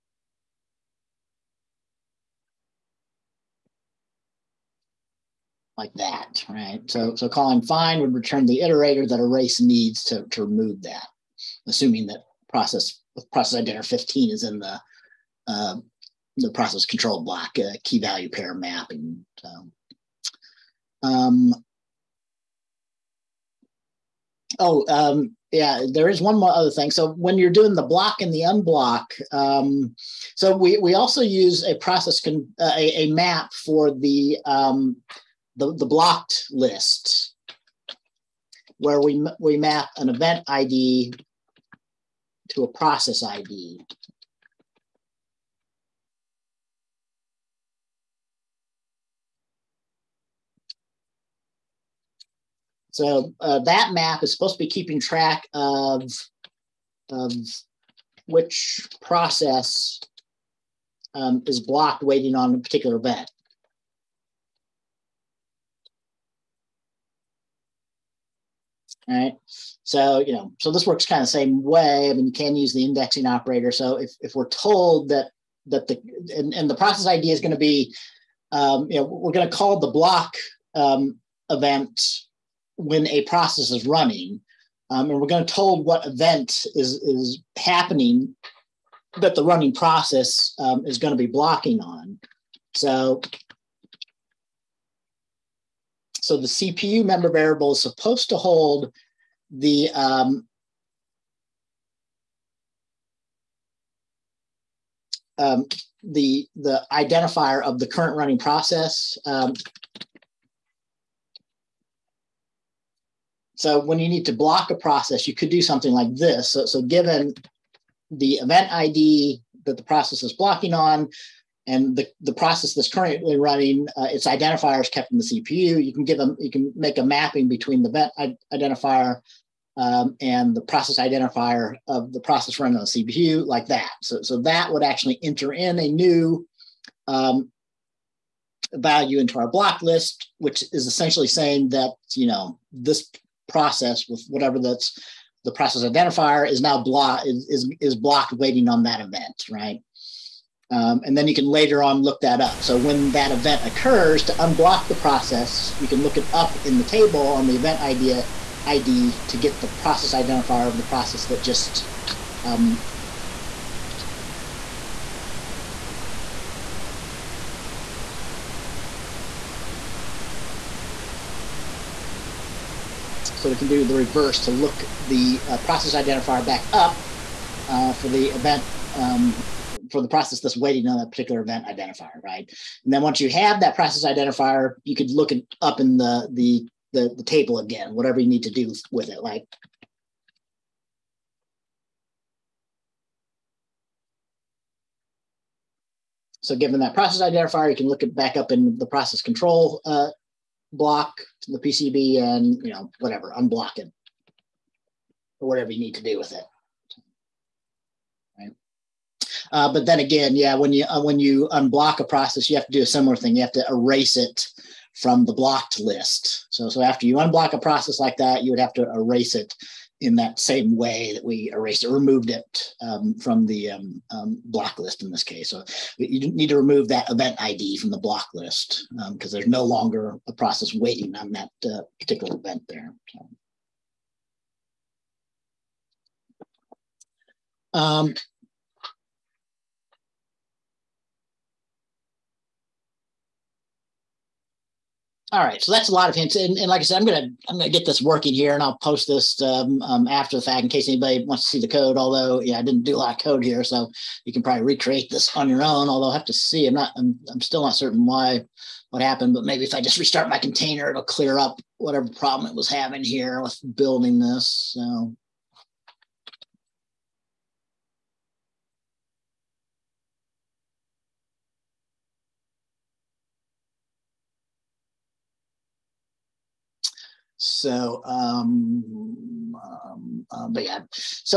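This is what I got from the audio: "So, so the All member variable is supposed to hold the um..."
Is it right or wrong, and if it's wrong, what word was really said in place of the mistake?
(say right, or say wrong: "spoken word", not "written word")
wrong: "CPU", not "All".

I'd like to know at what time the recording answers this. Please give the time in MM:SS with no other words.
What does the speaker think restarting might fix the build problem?
04:20.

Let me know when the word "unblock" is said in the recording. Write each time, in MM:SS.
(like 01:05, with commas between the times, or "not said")
00:28, 02:34, 03:23, 03:31, 03:37.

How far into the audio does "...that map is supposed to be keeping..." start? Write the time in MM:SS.
00:53.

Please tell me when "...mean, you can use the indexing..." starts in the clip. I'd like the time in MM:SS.
01:12.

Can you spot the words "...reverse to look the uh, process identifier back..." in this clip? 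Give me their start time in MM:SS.
02:53.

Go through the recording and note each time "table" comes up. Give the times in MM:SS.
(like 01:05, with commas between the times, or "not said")
02:36, 03:07.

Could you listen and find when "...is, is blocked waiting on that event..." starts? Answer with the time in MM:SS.
02:27.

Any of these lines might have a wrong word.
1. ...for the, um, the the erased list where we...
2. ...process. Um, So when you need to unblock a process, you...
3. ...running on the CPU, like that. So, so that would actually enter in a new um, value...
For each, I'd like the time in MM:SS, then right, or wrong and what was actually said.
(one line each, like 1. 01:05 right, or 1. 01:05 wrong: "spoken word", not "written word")
1. 00:33 wrong: "blocked", not "erased"
2. 01:48 wrong: "block", not "unblock"
3. 02:12 right.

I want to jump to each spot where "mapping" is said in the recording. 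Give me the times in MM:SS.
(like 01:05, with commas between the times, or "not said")
00:18, 02:07.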